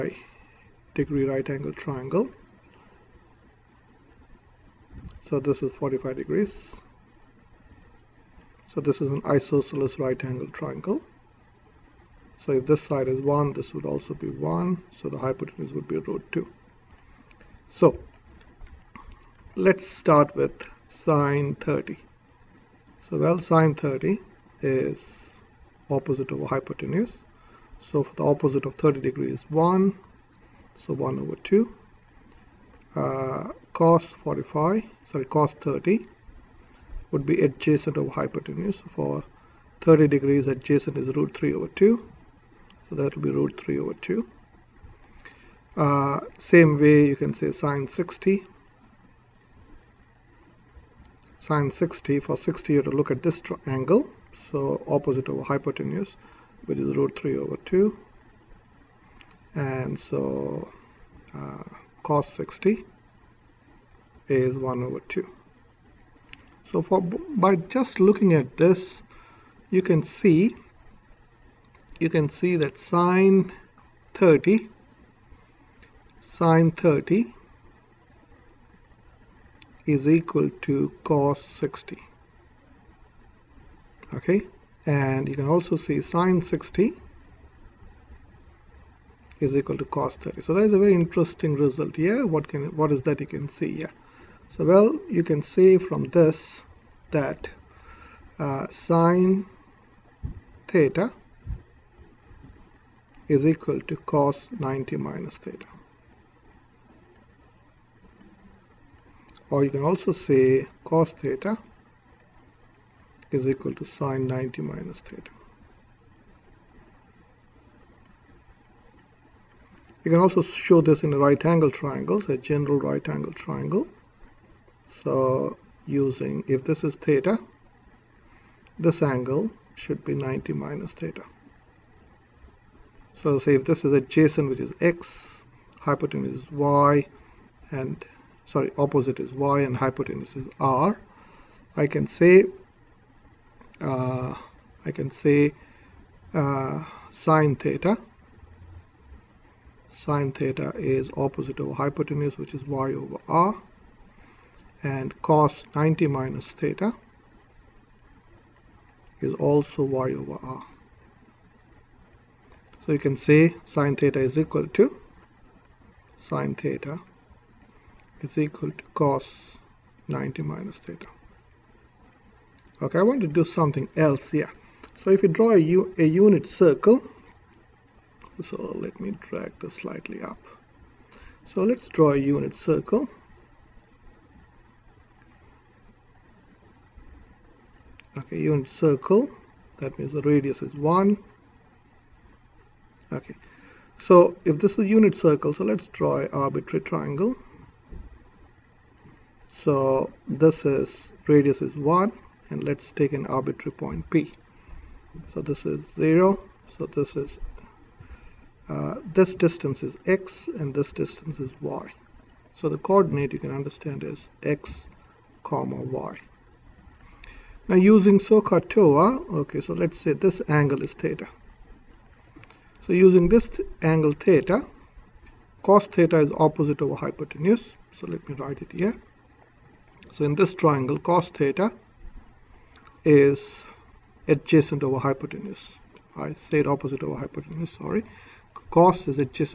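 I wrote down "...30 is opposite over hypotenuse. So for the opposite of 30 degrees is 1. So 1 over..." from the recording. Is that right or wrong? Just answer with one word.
right.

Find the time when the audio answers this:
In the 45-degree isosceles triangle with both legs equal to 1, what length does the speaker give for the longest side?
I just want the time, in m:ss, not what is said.
0:15.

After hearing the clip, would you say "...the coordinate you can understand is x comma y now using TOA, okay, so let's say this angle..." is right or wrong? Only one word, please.
right.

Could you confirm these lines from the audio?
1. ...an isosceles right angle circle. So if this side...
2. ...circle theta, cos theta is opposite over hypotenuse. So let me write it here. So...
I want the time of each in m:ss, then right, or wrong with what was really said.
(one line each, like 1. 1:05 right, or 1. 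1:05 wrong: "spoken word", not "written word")
1. 0:09 wrong: "triangle", not "circle"
2. 3:43 wrong: "angle", not "circle".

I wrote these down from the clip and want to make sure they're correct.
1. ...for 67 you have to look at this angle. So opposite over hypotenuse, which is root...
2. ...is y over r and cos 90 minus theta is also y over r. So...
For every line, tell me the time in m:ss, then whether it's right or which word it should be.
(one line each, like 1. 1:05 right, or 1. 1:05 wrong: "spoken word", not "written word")
1. 0:52 wrong: "60", not "67"
2. 2:32 right.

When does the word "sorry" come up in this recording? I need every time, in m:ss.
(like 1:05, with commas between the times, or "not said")
0:35, 2:18, 3:57.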